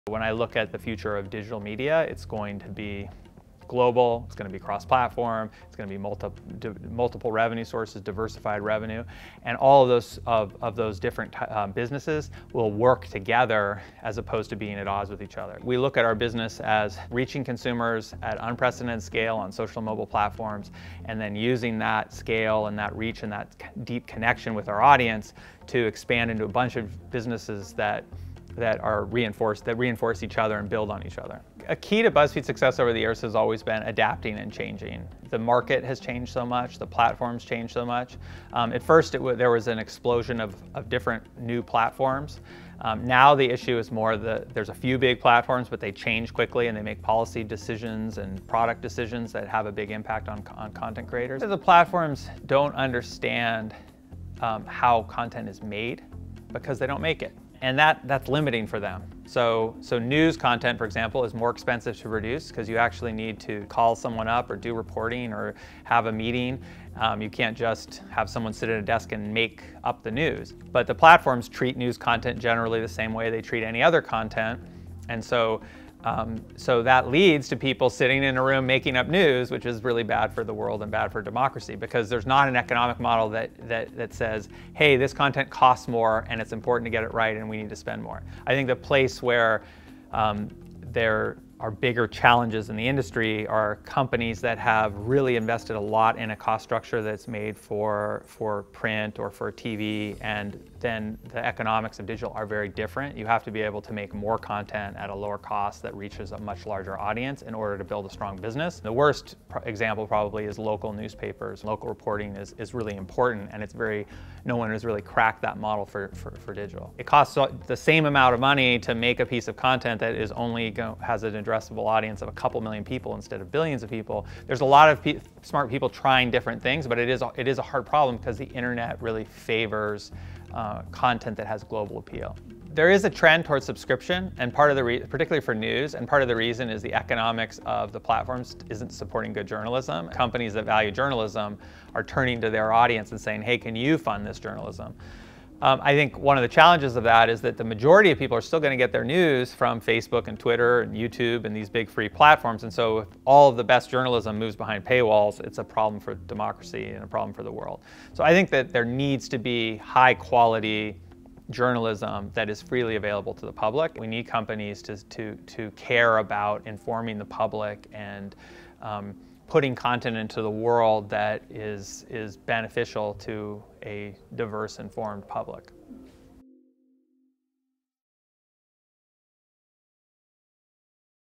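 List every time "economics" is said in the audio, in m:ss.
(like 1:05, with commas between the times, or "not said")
1:22, 1:41, 2:16.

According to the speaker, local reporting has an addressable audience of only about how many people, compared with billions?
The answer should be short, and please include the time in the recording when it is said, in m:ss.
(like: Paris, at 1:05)
A couple million, at 2:02.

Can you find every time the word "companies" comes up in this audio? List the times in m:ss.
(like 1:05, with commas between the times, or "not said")
1:33, 2:20, 2:44.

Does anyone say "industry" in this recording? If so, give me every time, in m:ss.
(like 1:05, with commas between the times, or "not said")
1:32.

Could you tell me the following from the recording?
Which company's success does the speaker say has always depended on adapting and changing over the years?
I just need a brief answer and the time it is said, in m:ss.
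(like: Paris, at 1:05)
BuzzFeed, at 0:32.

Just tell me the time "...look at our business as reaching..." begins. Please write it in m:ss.
0:15.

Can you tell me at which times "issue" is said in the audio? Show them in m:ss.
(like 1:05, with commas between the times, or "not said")
0:43.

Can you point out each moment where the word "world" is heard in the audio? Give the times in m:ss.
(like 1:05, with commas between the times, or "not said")
1:20, 2:37, 2:50.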